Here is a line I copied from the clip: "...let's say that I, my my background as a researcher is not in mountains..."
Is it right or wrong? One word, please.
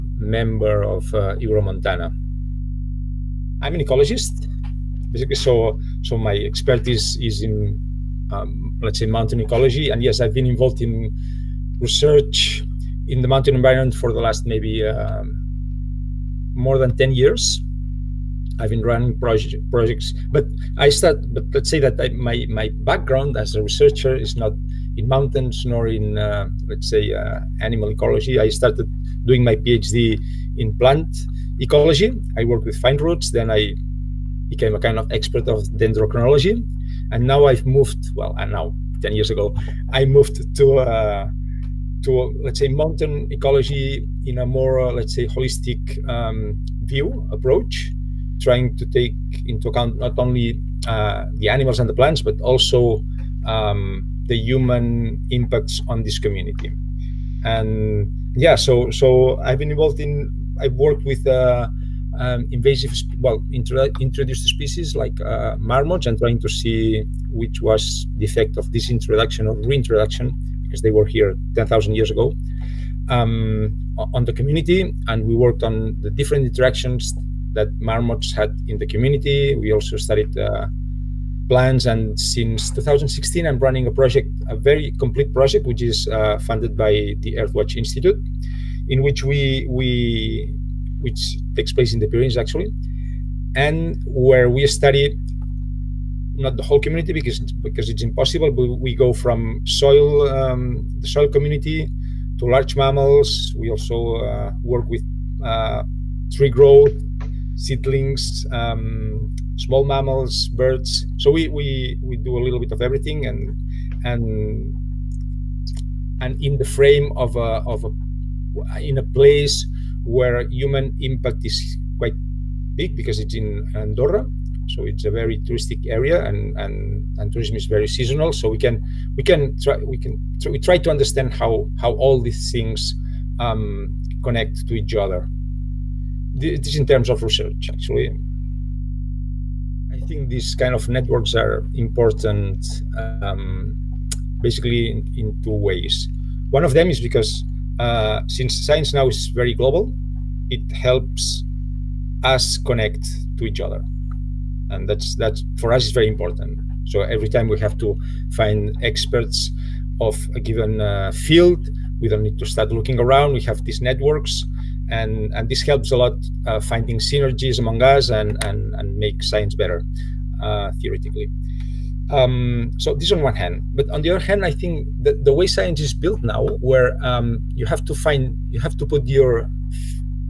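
right.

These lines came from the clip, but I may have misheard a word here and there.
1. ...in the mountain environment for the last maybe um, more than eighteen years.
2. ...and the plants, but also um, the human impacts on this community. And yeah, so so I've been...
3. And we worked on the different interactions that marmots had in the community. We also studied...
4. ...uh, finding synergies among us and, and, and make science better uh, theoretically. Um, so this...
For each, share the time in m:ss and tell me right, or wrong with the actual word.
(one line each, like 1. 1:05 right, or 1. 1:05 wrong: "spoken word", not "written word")
1. 0:13 wrong: "ten", not "eighteen"
2. 0:51 right
3. 1:15 right
4. 2:46 right.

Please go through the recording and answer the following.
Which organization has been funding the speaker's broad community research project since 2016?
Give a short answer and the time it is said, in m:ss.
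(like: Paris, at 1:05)
Earthwatch Institute, at 1:27.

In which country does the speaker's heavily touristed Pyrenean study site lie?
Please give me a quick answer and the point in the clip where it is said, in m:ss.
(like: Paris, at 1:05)
Andorra, at 2:03.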